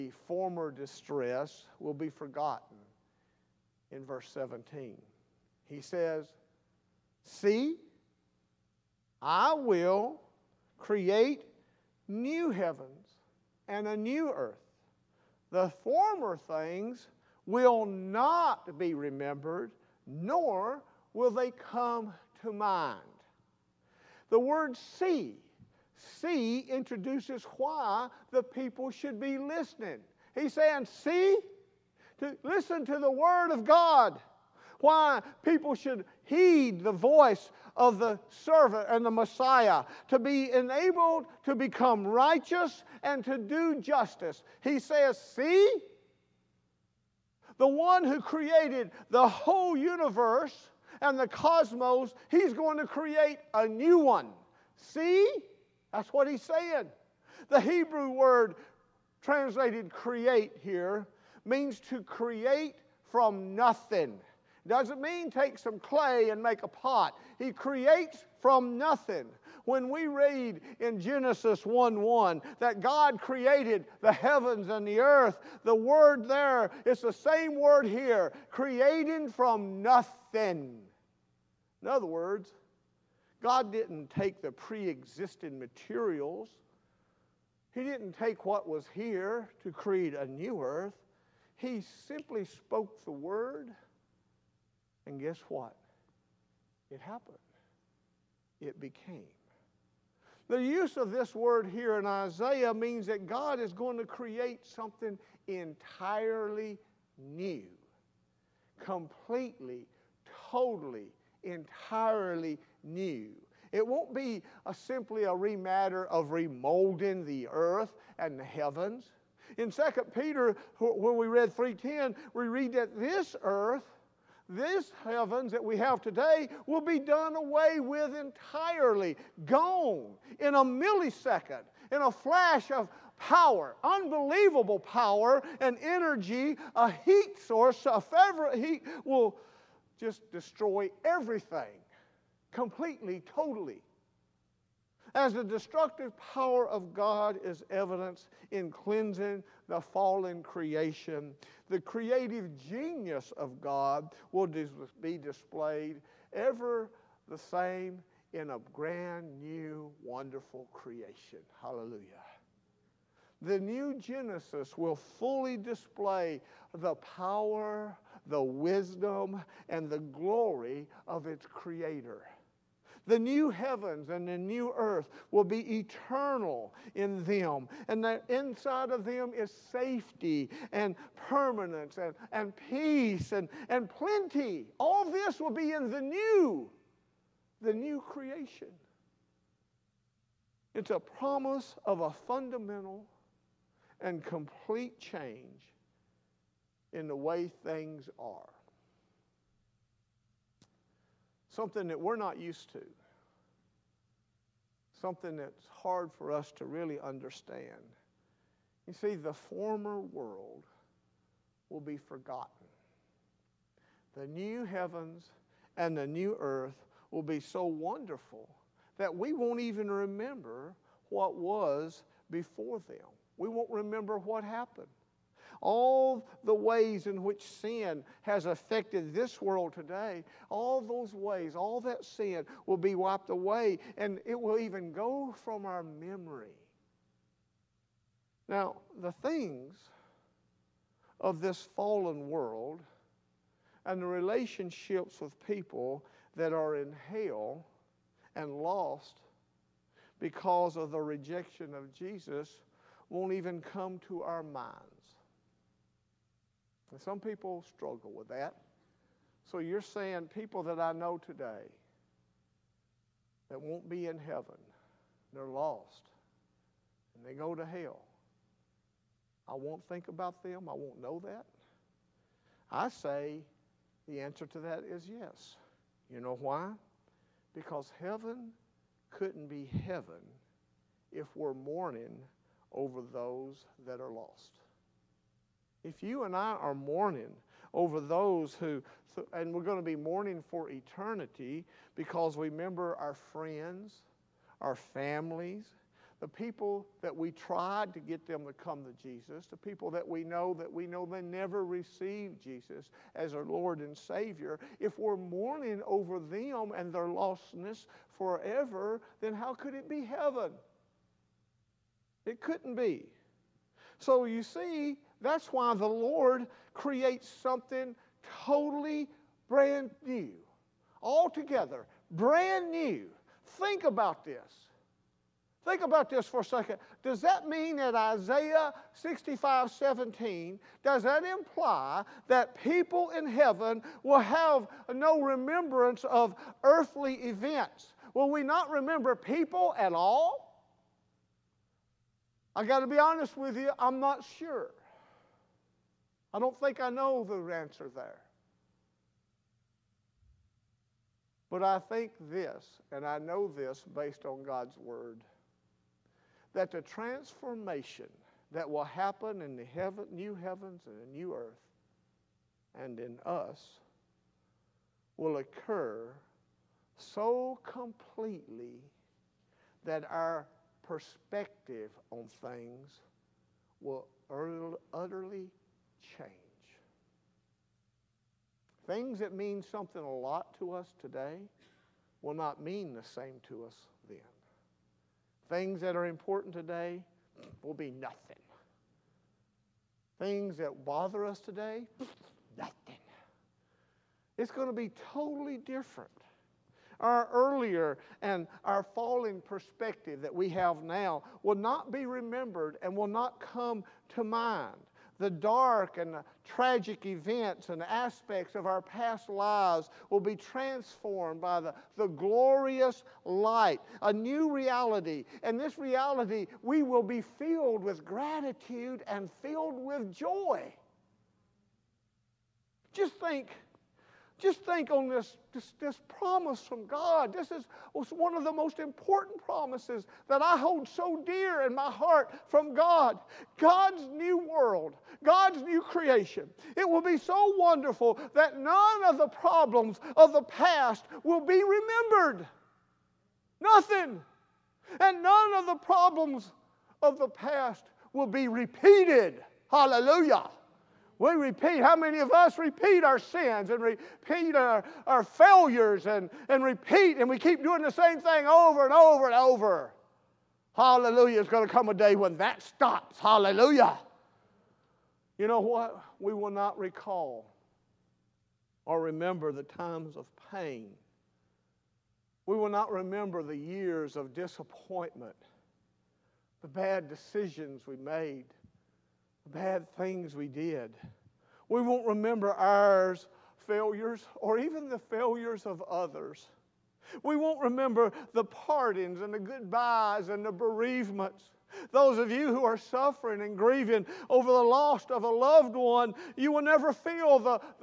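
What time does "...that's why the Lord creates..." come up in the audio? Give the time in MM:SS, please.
05:15.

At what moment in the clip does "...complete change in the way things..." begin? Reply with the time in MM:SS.
03:14.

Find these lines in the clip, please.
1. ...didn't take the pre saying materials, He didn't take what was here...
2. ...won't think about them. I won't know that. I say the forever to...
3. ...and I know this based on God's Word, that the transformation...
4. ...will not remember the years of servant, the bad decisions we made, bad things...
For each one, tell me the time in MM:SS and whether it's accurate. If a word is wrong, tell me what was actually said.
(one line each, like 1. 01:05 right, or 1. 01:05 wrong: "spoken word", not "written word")
1. 01:23 wrong: "existing", not "saying"
2. 04:29 wrong: "answer", not "forever"
3. 05:52 right
4. 07:52 wrong: "disappointment", not "servant".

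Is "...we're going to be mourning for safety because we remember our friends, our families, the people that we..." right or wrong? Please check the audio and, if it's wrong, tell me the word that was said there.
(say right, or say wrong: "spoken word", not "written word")
wrong: "eternity", not "safety".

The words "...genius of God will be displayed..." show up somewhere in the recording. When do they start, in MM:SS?
02:32.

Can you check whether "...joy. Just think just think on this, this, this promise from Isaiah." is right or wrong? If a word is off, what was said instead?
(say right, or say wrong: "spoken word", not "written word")
wrong: "God", not "Isaiah".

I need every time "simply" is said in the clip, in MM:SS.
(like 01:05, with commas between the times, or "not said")
01:32, 01:54.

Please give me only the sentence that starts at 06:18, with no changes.
Things that mean something a lot to us today will not mean the same to us then.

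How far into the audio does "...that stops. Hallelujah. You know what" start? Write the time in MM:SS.
07:42.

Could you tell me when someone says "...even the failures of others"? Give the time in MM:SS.
08:04.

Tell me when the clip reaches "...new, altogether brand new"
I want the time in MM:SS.
05:20.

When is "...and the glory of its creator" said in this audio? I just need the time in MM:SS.
02:49.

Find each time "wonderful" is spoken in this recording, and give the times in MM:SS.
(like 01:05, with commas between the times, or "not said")
02:40, 03:37, 07:17.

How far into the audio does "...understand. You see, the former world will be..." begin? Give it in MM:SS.
03:26.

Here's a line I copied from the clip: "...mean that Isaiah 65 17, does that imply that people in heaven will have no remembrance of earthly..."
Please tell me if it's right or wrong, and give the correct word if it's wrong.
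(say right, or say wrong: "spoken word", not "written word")
right.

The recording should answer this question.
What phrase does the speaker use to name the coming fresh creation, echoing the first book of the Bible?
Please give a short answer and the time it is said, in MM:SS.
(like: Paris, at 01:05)
The new Genesis, at 02:43.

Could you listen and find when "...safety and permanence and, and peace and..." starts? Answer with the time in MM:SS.
02:59.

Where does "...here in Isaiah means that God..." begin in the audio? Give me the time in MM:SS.
01:41.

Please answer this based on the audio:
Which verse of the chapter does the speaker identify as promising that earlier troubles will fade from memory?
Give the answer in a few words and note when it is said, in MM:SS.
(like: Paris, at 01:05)
Verse 17, at 00:04.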